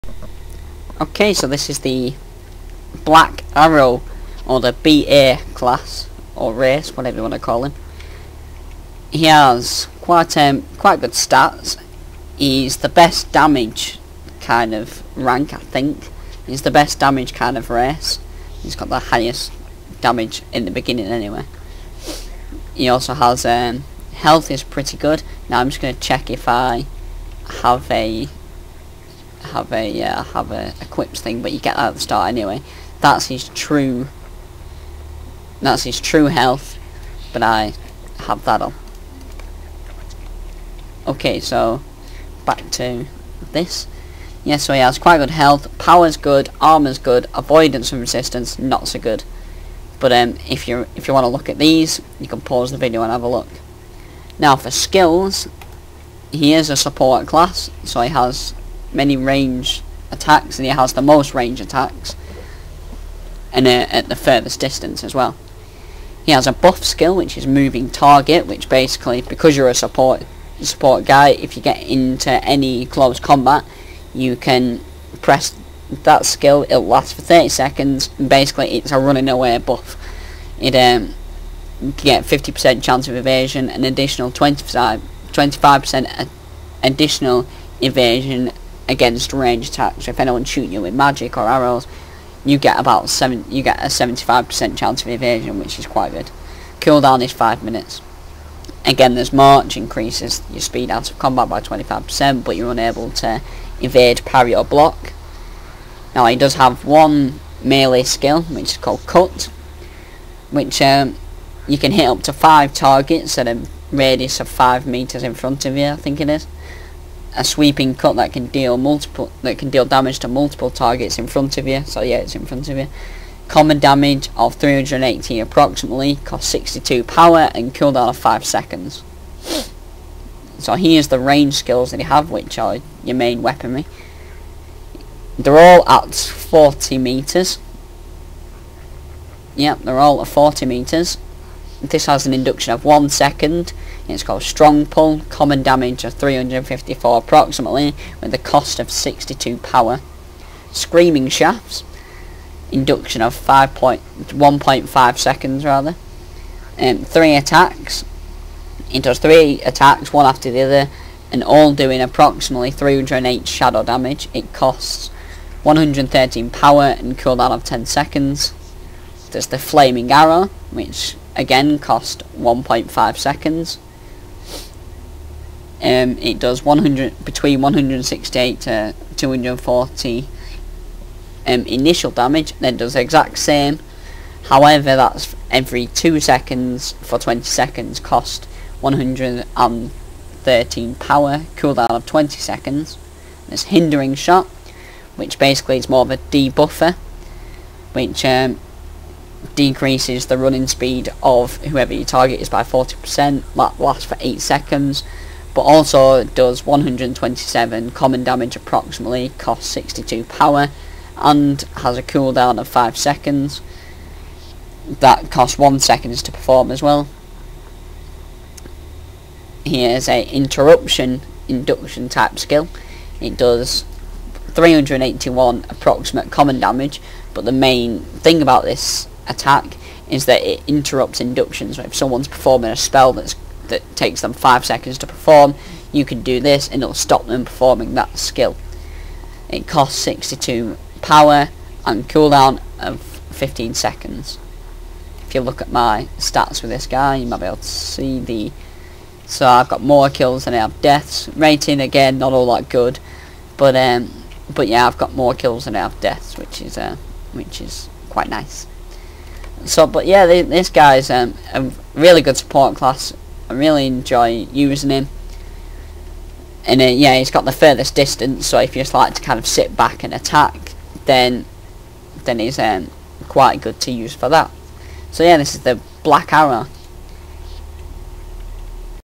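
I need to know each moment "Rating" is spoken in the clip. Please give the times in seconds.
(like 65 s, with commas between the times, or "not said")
251 s.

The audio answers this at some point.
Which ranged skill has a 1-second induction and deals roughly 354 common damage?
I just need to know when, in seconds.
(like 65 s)
144 s.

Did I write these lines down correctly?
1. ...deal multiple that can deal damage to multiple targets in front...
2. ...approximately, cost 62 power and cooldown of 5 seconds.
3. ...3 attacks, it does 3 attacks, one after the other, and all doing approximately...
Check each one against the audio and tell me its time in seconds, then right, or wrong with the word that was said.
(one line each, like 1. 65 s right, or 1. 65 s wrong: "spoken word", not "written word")
1. 118 s right
2. 125 s right
3. 156 s right.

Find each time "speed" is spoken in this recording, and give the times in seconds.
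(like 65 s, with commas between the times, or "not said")
100 s, 200 s.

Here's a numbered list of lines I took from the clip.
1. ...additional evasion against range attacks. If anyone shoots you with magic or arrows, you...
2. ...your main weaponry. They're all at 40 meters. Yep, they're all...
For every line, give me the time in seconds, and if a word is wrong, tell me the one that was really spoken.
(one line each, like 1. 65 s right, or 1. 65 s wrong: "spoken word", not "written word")
1. 86 s right
2. 133 s right.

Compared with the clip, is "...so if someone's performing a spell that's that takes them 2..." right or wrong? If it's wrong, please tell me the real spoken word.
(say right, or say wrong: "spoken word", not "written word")
wrong: "5", not "2".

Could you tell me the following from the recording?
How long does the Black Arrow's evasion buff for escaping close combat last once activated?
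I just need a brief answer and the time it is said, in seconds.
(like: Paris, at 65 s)
30 seconds, at 77 s.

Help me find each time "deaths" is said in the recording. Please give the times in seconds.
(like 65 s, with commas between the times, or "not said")
250 s, 256 s.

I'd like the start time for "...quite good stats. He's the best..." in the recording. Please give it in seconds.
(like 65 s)
10 s.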